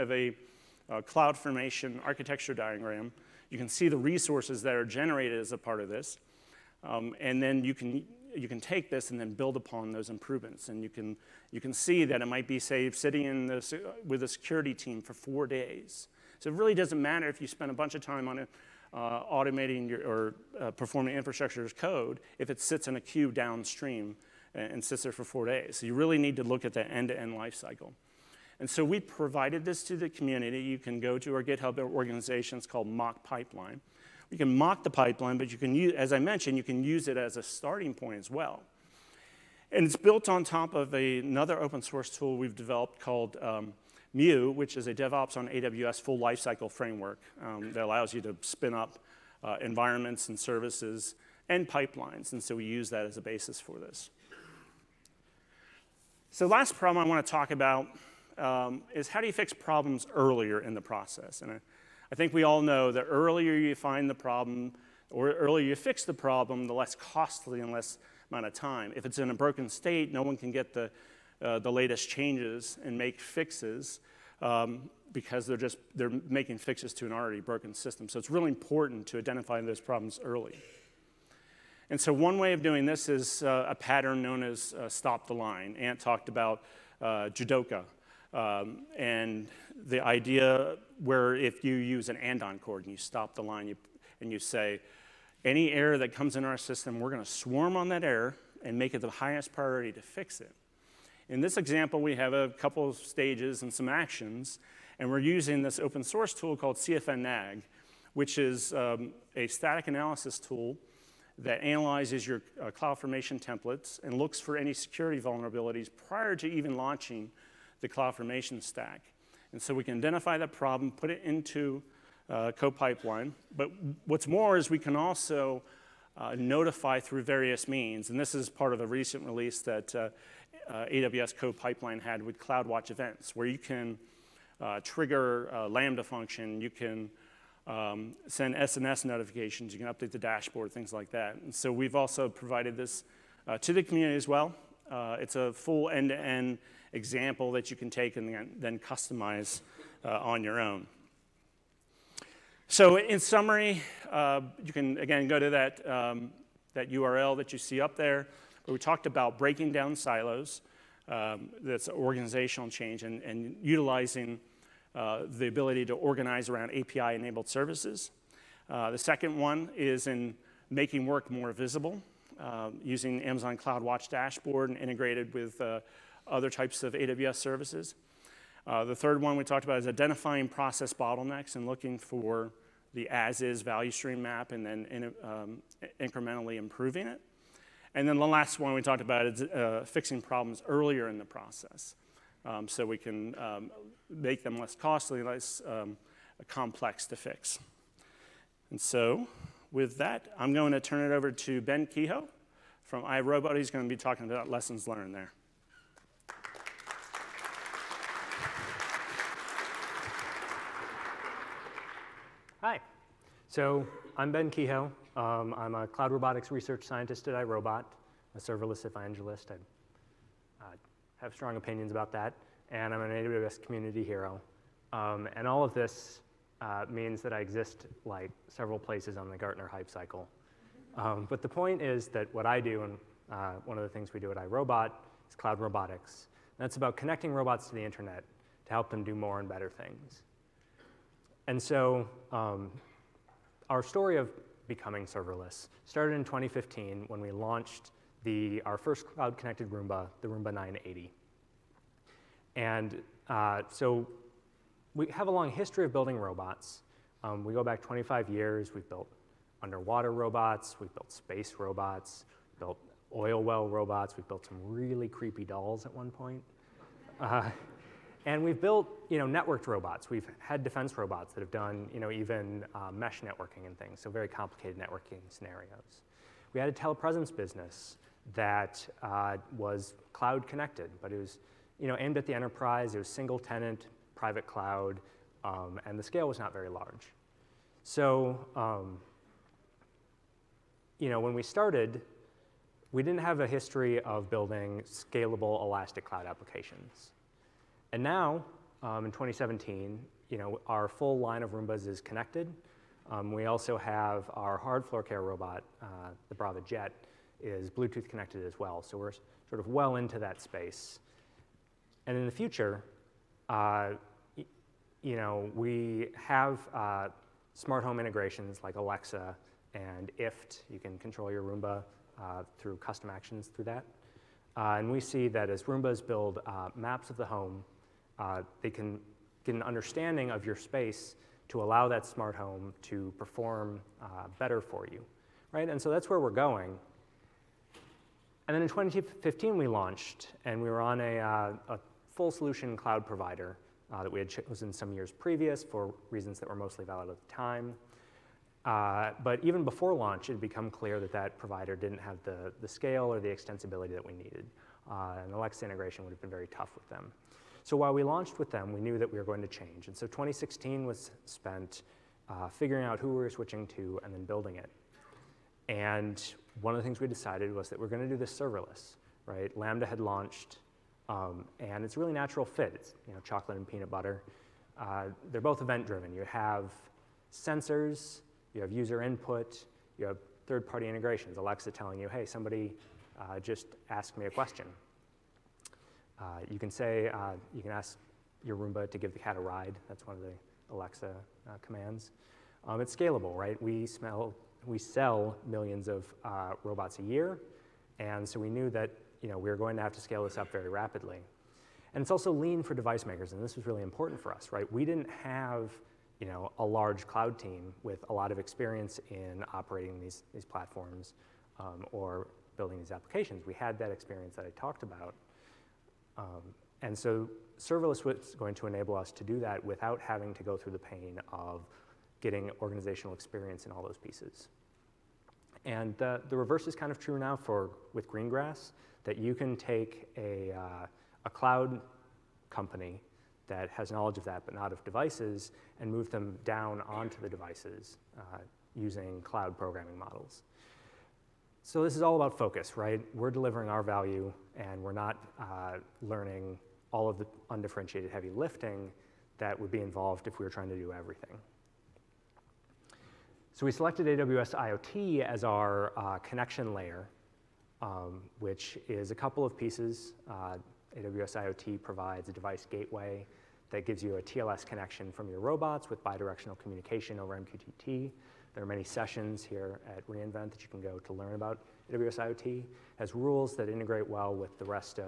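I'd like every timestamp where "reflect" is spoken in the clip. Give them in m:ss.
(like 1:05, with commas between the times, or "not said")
not said.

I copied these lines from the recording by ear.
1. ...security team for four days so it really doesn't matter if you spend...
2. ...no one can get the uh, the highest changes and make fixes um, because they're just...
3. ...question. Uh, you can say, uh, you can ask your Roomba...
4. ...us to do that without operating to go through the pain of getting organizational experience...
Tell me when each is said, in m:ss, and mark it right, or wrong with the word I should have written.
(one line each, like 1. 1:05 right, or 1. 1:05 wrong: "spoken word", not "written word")
1. 0:14 right
2. 1:10 wrong: "latest", not "highest"
3. 6:24 right
4. 6:58 wrong: "having", not "operating".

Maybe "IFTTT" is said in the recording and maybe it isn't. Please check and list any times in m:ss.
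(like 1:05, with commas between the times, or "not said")
5:20.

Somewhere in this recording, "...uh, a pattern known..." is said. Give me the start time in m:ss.
1:23.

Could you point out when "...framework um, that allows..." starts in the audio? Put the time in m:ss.
0:46.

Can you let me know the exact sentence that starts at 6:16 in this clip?
You have sensors, you have user input, you have third-party integrations.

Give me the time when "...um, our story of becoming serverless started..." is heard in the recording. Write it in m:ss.
4:02.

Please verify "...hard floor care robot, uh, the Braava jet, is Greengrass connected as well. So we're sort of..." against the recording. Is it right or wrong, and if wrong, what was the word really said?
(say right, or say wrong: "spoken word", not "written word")
wrong: "Bluetooth", not "Greengrass".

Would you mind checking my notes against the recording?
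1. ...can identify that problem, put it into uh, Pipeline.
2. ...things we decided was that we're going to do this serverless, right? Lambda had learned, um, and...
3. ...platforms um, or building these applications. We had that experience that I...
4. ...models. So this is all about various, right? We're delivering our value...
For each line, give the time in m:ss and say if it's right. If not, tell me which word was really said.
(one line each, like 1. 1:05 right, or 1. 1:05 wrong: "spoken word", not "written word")
1. 1:59 wrong: "CodePipeline", not "Pipeline"
2. 6:06 wrong: "launched", not "learned"
3. 6:50 right
4. 7:19 wrong: "focus", not "various".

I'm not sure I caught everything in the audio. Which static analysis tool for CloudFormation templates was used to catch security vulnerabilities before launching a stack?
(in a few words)
cfn_nag.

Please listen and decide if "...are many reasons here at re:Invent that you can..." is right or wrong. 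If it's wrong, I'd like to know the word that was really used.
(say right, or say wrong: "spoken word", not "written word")
wrong: "sessions", not "reasons".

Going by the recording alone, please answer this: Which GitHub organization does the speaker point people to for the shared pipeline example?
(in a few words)
Mock Pipeline.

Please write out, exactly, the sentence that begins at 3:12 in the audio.
Um, so we can um, make them less costly, less um, complex to fix.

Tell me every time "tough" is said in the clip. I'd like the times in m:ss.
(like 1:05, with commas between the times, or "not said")
5:56.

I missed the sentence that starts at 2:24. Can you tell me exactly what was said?
it's a full end-to-end example that you can take and then customize on your own.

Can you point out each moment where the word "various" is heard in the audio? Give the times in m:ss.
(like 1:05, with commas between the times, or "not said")
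2:07.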